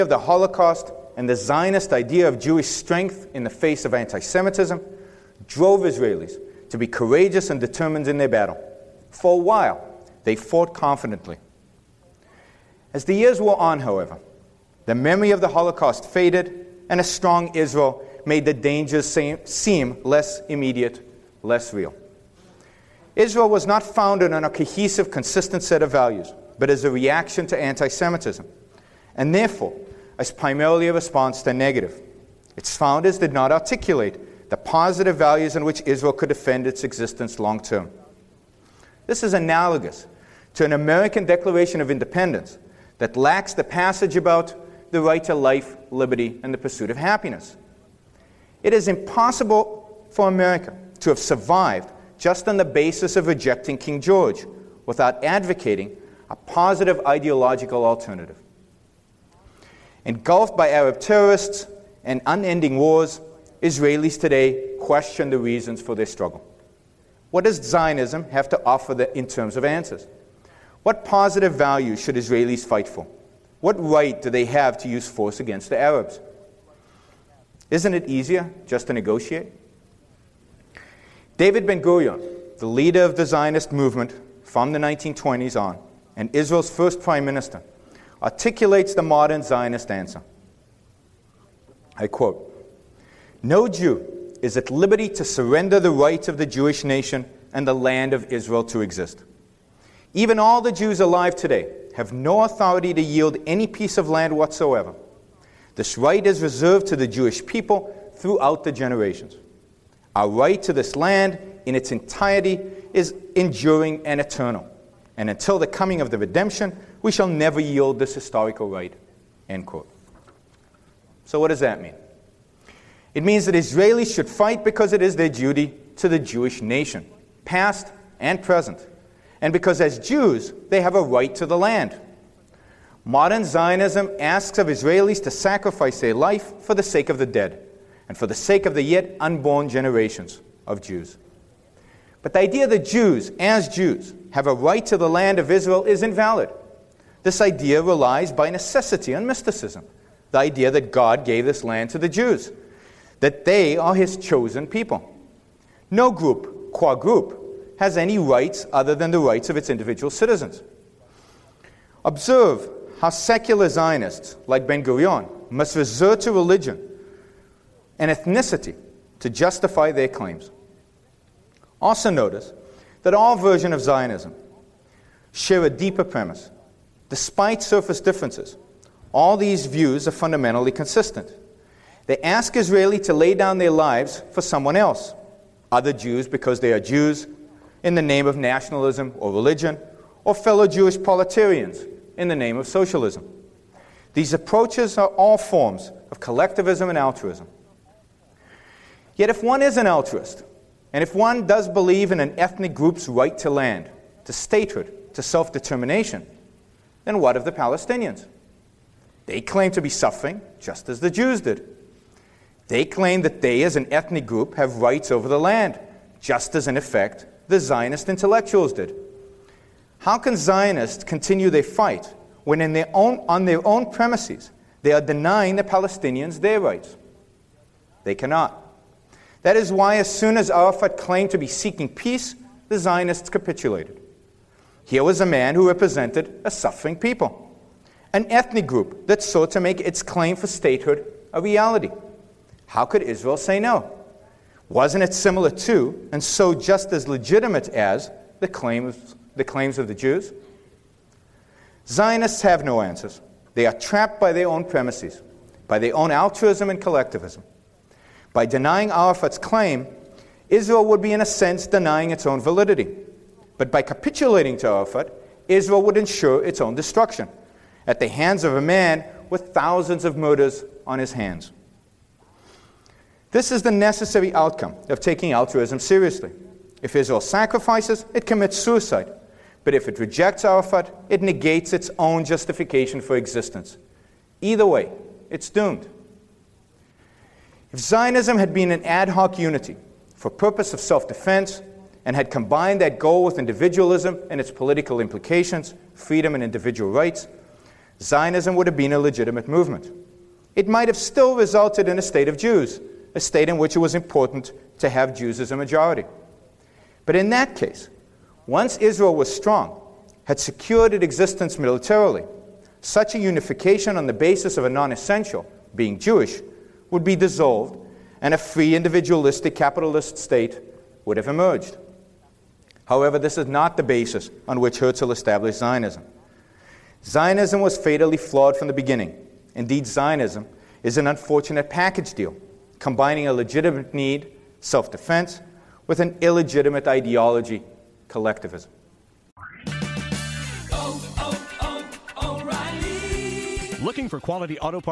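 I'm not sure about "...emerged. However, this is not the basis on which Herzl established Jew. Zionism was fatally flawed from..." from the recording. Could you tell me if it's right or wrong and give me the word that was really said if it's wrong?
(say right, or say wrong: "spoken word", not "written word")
wrong: "Zionism", not "Jew".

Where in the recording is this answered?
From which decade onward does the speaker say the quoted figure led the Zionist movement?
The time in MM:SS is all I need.
01:24.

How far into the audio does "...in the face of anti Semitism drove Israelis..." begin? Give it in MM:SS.
00:03.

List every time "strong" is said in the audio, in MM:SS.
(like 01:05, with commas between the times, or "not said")
00:17, 05:09.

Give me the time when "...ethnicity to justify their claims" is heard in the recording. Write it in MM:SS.
02:48.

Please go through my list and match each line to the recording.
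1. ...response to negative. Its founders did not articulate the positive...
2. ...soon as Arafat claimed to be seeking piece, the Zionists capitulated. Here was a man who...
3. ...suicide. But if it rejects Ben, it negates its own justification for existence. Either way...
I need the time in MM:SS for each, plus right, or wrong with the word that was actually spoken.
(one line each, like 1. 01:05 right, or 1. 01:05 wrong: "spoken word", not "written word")
1. 00:30 right
2. 03:50 wrong: "peace", not "piece"
3. 04:38 wrong: "Arafat", not "Ben".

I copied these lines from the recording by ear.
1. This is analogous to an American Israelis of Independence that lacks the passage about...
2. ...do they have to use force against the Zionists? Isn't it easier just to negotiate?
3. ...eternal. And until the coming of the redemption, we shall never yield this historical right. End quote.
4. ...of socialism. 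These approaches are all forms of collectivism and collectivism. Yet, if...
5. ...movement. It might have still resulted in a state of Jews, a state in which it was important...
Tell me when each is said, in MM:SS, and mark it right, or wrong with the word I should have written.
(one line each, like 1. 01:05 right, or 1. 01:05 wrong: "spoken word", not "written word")
1. 00:39 wrong: "Declaration", not "Israelis"
2. 01:14 wrong: "Arabs", not "Zionists"
3. 01:54 right
4. 03:12 wrong: "altruism", not "collectivism"
5. 04:59 right.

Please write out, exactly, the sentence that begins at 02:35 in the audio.
No group, qua group, has any rights other than the rights of its individual citizens.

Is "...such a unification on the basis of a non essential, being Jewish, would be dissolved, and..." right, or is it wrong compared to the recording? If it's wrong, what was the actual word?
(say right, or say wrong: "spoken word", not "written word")
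right.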